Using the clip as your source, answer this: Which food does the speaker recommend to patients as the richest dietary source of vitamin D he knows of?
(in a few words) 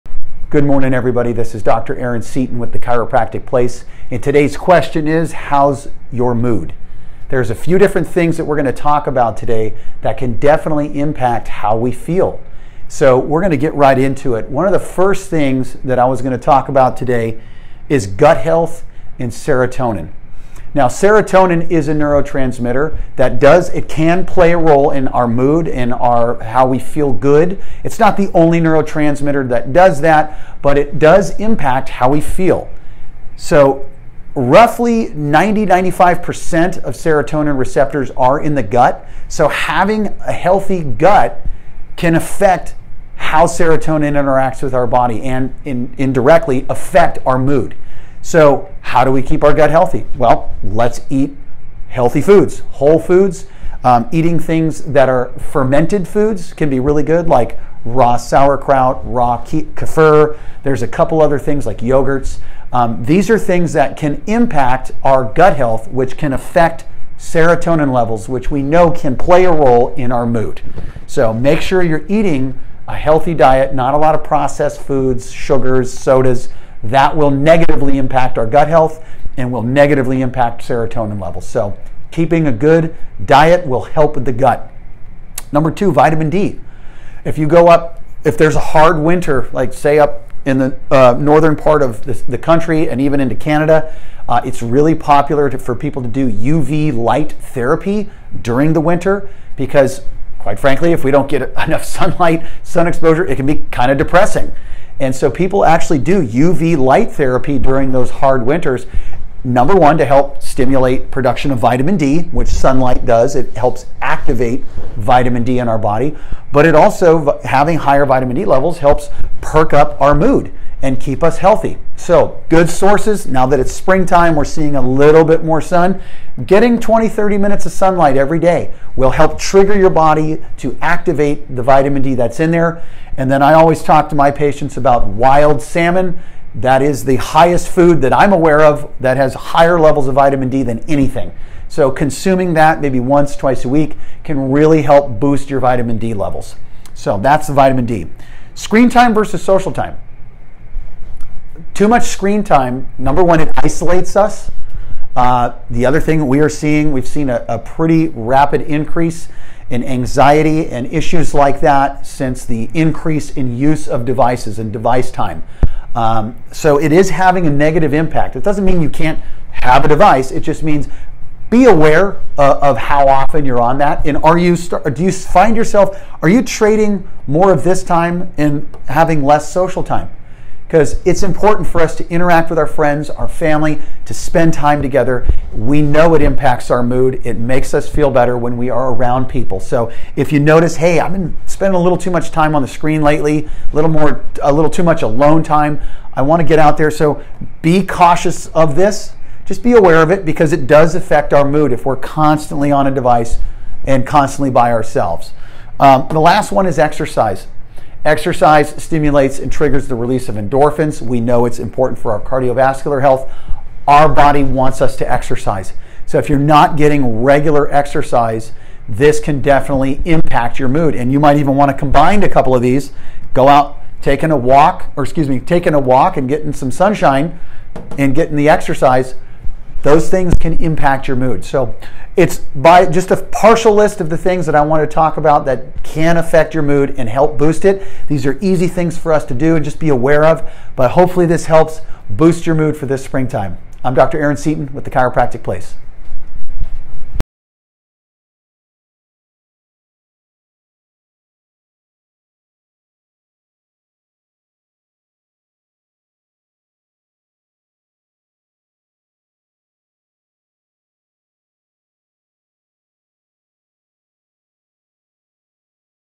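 Wild salmon.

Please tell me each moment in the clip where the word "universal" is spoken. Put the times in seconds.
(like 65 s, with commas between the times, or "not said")
not said.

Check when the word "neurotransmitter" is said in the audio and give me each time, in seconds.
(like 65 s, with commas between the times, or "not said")
21 s, 28 s.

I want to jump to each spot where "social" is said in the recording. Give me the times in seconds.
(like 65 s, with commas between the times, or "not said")
149 s, 179 s.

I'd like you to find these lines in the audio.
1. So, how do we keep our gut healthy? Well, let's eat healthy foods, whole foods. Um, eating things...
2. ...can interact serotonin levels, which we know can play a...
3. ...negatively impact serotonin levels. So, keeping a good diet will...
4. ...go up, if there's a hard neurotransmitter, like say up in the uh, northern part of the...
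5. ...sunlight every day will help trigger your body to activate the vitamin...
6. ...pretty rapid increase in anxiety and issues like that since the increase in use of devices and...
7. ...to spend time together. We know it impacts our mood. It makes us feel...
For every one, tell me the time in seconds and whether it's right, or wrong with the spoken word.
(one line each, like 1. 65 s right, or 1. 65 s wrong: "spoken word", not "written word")
1. 48 s right
2. 66 s wrong: "affect", not "interact"
3. 79 s right
4. 87 s wrong: "winter", not "neurotransmitter"
5. 127 s right
6. 157 s right
7. 184 s right.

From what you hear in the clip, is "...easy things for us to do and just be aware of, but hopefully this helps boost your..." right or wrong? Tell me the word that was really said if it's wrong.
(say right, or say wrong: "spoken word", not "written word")
right.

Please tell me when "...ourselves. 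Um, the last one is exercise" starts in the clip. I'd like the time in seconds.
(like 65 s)
204 s.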